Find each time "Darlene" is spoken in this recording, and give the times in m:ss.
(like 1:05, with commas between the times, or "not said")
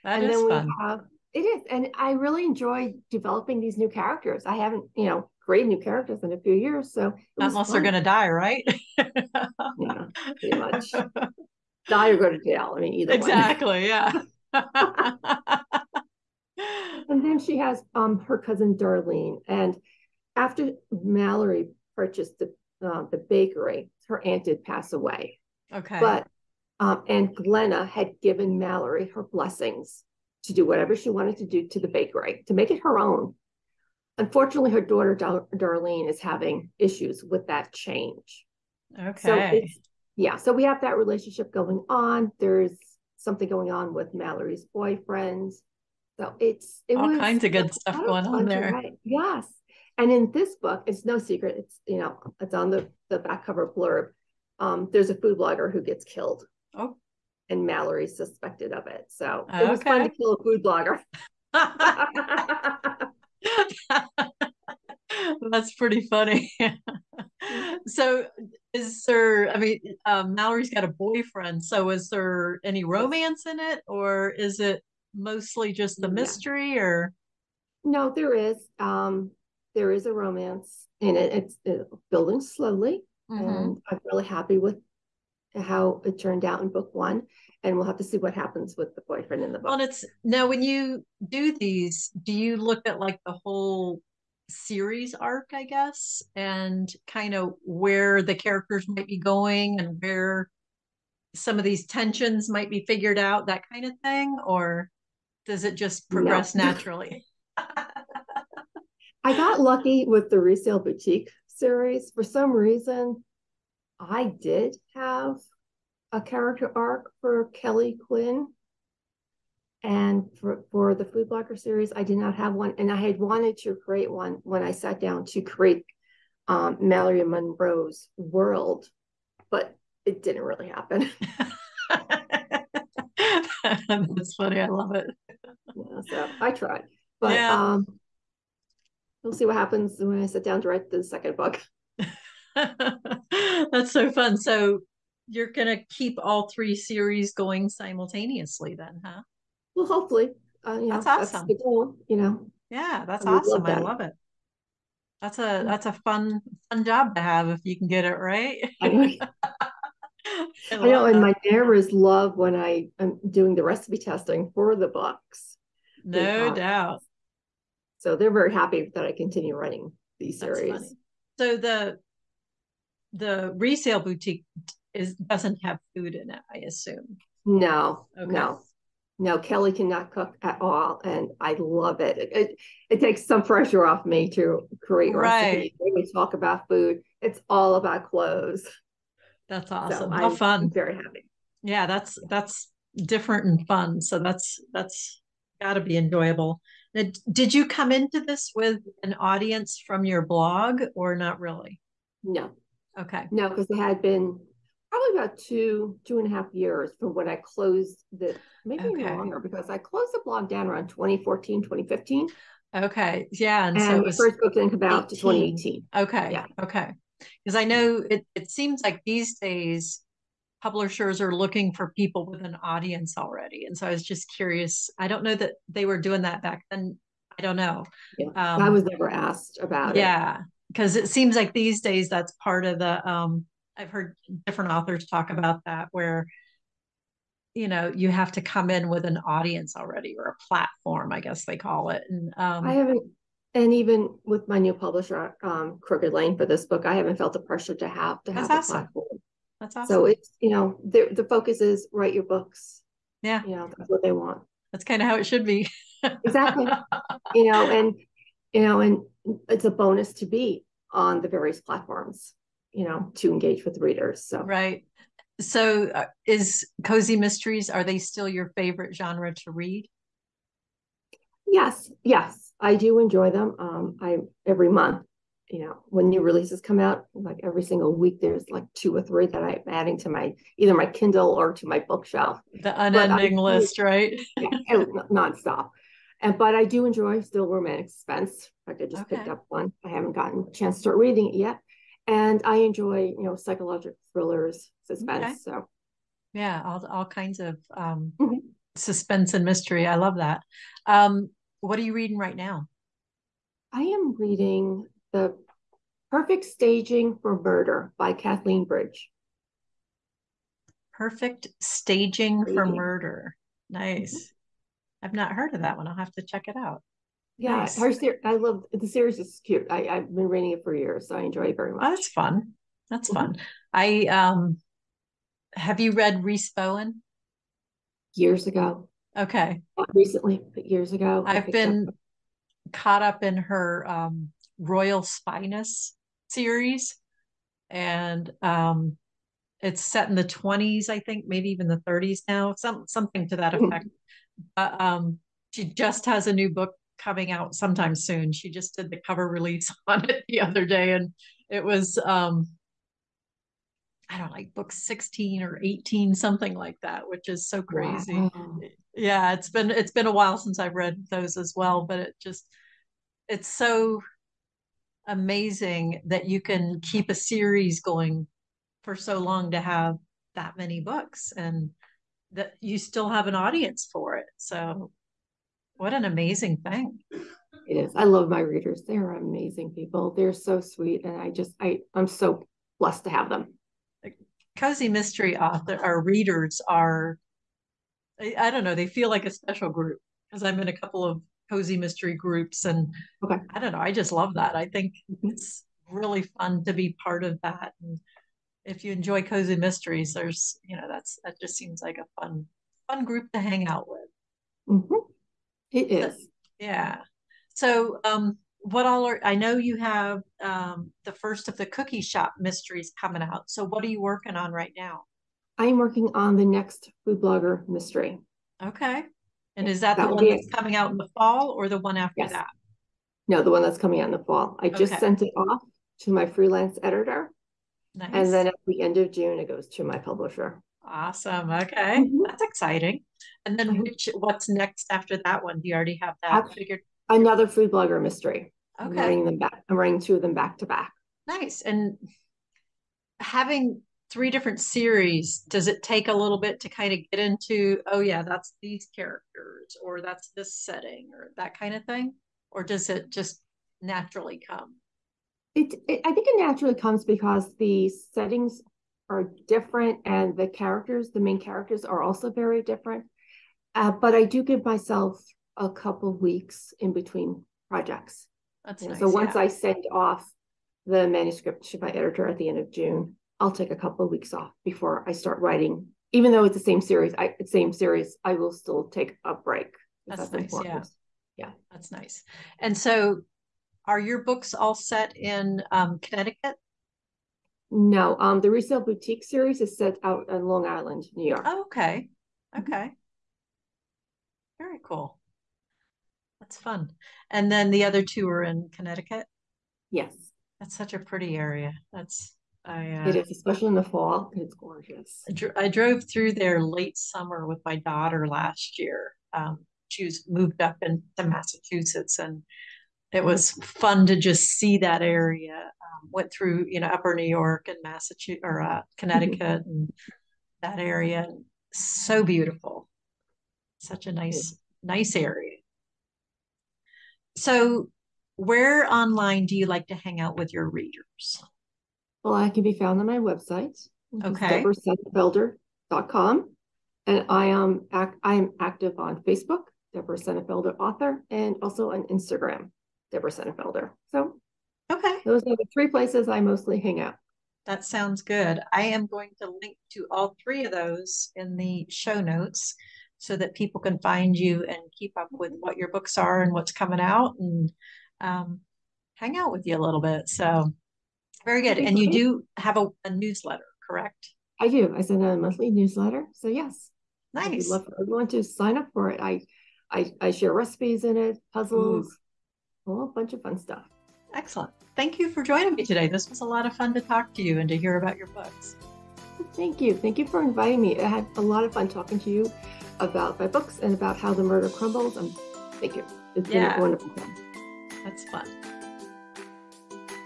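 0:18, 0:35.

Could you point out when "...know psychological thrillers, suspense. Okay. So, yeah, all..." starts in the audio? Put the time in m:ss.
4:53.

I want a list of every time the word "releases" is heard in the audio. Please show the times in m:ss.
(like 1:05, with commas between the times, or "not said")
4:36, 5:49.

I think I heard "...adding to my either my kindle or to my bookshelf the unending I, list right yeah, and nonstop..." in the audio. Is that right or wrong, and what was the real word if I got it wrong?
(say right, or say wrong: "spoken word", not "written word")
right.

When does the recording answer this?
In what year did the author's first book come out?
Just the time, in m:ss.
3:35.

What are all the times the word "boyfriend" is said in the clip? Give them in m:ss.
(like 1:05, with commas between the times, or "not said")
0:44, 1:10, 1:29.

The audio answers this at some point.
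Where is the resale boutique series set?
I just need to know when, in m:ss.
8:10.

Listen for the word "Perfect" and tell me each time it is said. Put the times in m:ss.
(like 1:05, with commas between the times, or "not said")
5:06, 5:10.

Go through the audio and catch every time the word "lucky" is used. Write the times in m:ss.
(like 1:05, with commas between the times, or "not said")
1:49.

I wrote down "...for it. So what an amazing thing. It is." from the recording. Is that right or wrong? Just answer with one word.
right.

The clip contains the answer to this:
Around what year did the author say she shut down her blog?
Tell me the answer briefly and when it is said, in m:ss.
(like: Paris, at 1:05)
2014, at 3:30.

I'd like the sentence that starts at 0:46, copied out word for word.
So it's it all was, kinds of good stuff going on there.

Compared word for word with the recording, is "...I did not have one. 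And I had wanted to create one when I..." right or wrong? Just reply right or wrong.
right.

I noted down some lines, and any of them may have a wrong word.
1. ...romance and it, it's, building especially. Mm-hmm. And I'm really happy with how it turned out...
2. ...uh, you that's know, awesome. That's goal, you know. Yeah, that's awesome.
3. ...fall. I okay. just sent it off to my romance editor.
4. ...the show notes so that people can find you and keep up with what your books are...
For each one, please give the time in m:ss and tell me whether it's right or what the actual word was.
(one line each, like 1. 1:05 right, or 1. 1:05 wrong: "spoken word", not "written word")
1. 1:20 wrong: "slowly", not "especially"
2. 2:30 right
3. 7:04 wrong: "freelance", not "romance"
4. 9:11 right.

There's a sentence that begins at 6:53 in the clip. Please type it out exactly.
So, what are you working on right now?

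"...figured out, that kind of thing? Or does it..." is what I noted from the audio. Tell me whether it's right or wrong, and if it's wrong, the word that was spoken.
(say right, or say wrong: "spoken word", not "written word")
right.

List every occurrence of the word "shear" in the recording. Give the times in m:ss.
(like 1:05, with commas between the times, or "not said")
not said.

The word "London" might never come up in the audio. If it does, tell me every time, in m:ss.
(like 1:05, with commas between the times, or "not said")
not said.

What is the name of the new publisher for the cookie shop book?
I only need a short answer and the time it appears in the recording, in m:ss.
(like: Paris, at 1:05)
Crooked Lane, at 4:05.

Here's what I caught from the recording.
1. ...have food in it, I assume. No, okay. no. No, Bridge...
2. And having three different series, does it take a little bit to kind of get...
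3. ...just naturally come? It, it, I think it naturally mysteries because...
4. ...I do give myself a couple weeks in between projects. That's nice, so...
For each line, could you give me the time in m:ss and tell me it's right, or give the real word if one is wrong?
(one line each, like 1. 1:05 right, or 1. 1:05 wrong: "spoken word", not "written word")
1. 2:55 wrong: "Kelly", not "Bridge"
2. 7:21 right
3. 7:33 wrong: "comes", not "mysteries"
4. 7:44 right.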